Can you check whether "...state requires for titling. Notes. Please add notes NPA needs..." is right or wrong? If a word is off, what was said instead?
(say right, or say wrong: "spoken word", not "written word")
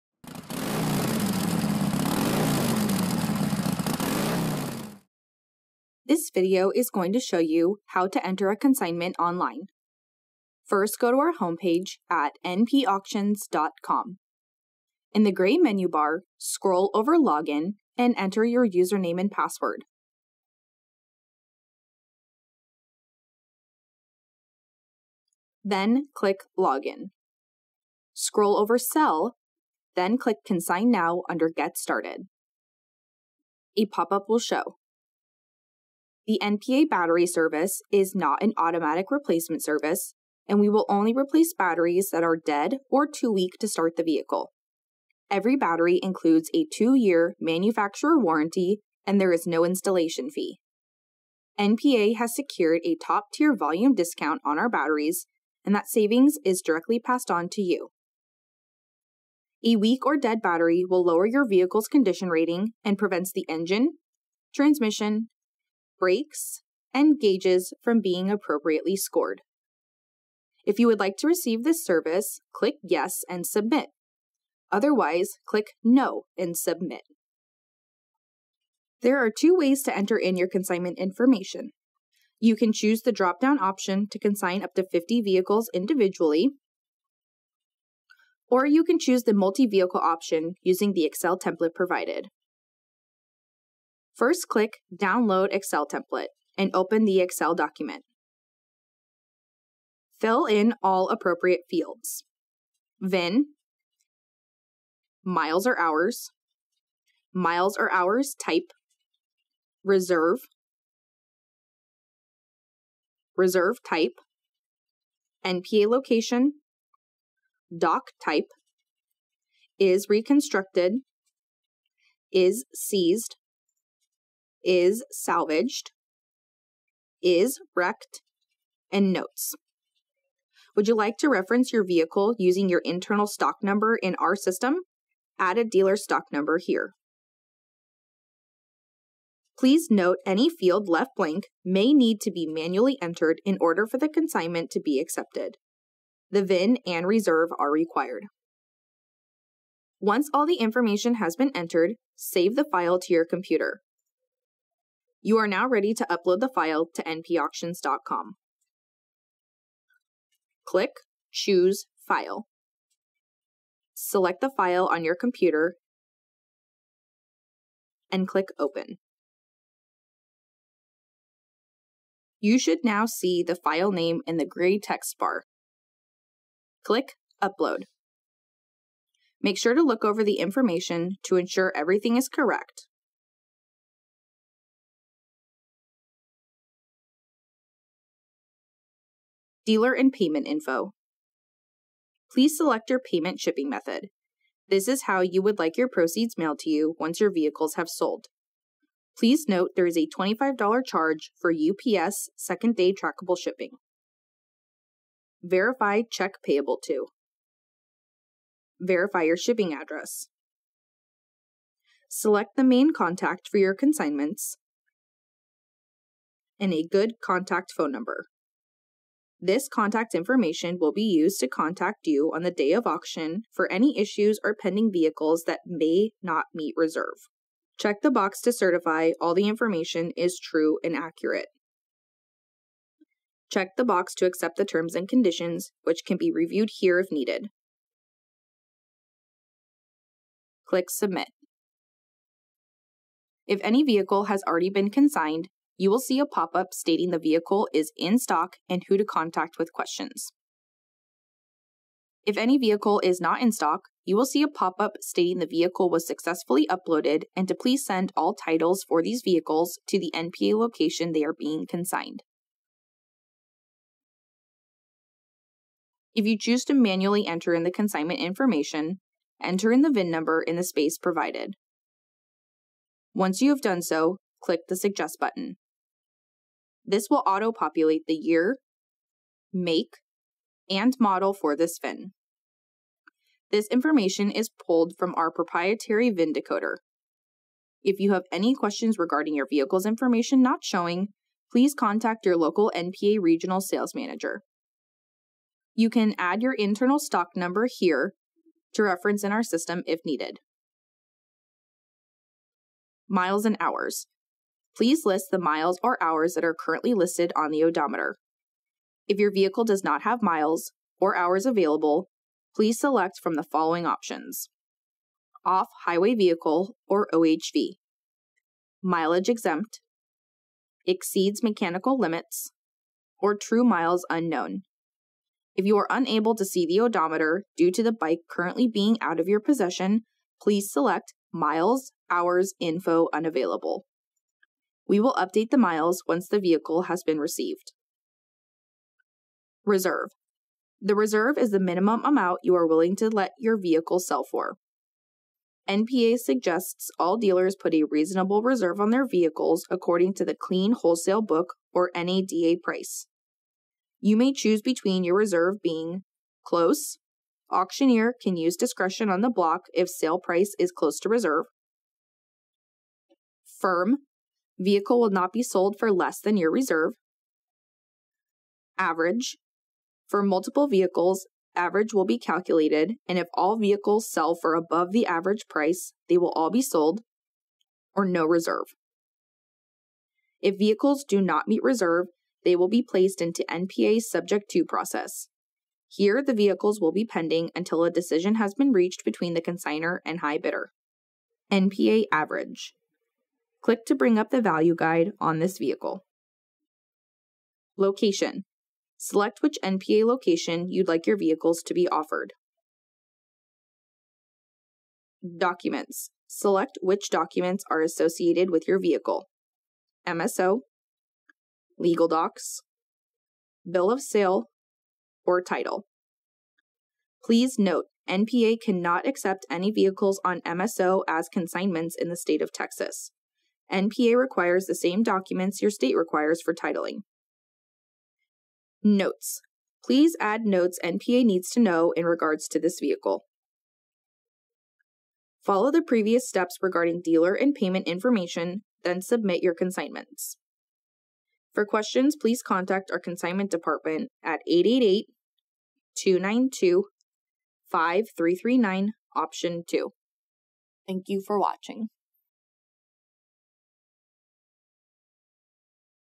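right.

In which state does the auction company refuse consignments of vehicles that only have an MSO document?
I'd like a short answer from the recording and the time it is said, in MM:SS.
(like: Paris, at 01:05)
Texas, at 07:02.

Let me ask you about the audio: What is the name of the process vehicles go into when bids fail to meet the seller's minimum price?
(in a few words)
Subject to.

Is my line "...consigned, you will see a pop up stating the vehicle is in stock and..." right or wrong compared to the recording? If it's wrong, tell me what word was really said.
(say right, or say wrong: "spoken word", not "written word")
right.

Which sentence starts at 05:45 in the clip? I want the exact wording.
NPA suggests all dealers put a reasonable reserve on their vehicles according to the Clean Wholesale Book or NADA price.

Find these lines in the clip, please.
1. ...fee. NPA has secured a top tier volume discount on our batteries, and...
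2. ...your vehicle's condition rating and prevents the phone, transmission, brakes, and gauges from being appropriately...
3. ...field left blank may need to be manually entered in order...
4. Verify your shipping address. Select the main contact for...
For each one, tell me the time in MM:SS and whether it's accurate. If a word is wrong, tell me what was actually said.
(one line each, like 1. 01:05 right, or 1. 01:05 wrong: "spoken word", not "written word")
1. 00:50 right
2. 01:01 wrong: "engine", not "phone"
3. 02:20 right
4. 03:28 right.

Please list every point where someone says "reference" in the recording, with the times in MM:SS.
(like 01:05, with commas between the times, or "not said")
02:11, 04:58.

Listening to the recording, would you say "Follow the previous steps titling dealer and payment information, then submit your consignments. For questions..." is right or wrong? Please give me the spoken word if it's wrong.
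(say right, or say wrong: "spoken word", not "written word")
wrong: "regarding", not "titling".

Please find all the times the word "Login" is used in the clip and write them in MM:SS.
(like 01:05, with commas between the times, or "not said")
00:17, 00:26.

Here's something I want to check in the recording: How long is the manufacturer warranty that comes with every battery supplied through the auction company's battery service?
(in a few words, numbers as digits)
2 years.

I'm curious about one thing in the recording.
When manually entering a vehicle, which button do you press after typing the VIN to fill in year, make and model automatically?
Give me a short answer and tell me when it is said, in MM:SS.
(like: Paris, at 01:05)
Suggest, at 04:34.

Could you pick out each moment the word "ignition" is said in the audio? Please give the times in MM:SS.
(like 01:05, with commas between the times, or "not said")
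not said.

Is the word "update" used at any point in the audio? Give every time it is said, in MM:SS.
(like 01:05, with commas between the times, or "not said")
05:35.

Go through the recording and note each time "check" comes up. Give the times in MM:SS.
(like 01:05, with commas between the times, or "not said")
03:26, 03:47, 03:53.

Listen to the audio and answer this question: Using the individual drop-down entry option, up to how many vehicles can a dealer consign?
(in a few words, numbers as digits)
50.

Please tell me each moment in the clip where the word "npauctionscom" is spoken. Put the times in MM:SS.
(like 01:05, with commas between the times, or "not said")
00:12, 02:37.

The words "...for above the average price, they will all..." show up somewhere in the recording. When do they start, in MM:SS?
06:14.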